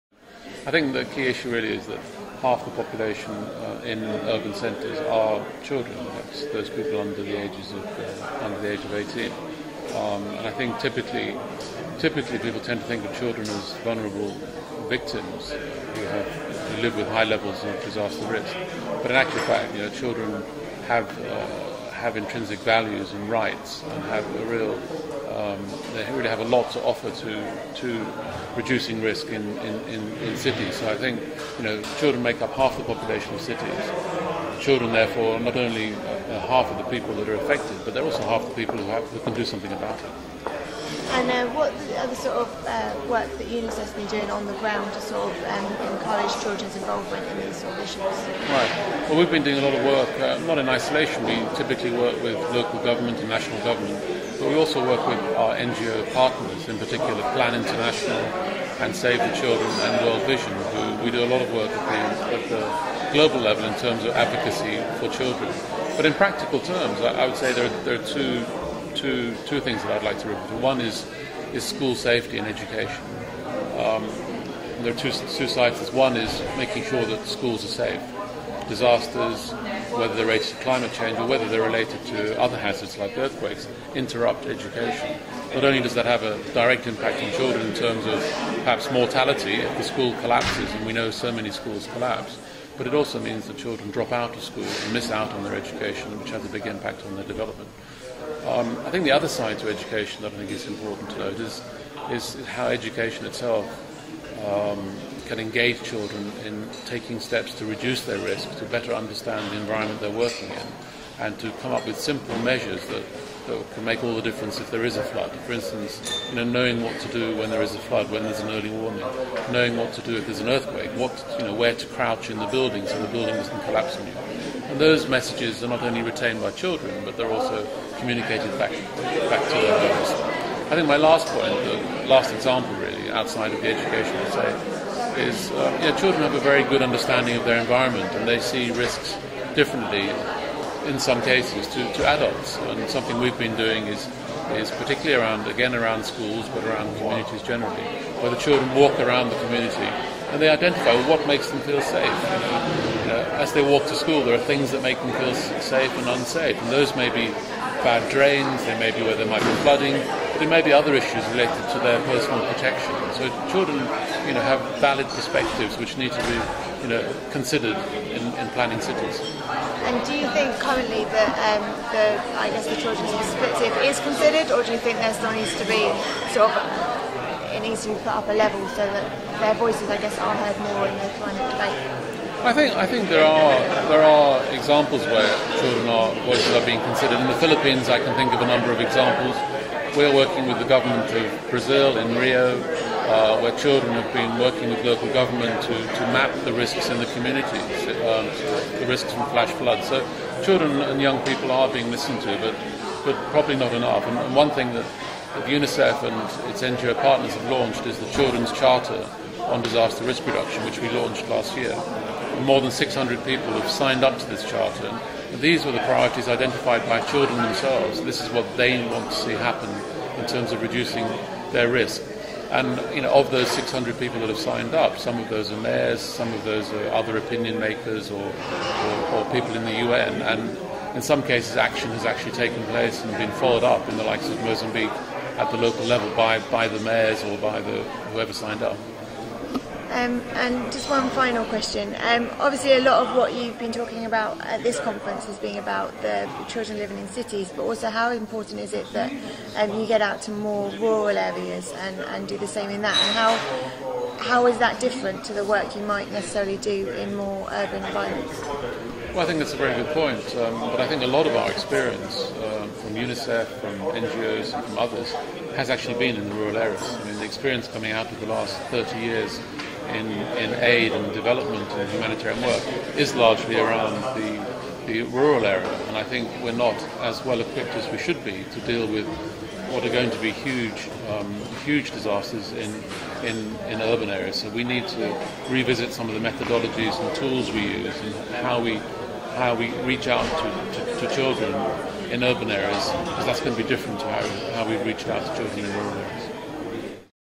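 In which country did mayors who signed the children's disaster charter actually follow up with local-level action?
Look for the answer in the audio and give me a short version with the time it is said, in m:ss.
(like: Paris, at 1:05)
Mozambique, at 3:54.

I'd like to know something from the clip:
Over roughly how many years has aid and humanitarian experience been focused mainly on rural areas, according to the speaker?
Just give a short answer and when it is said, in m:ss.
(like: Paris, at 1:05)
30 years, at 4:28.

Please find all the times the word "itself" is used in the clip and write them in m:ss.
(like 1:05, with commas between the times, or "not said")
1:43.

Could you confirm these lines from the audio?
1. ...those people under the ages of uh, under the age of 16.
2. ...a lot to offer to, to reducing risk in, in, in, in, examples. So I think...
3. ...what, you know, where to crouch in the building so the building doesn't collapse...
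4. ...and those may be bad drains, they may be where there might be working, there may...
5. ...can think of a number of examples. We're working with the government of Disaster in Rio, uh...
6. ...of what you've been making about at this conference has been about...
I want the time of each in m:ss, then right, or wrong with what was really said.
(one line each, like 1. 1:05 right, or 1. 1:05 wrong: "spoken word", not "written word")
1. 0:06 wrong: "18", not "16"
2. 0:26 wrong: "cities", not "examples"
3. 2:00 right
4. 2:36 wrong: "flooding", not "working"
5. 3:07 wrong: "Brazil", not "Disaster"
6. 4:03 wrong: "talking", not "making".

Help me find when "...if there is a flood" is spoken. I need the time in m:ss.
1:54.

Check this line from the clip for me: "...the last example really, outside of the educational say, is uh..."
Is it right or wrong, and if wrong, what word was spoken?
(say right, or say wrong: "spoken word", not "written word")
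right.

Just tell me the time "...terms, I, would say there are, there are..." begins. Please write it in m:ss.
1:06.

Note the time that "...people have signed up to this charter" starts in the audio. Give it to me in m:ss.
3:33.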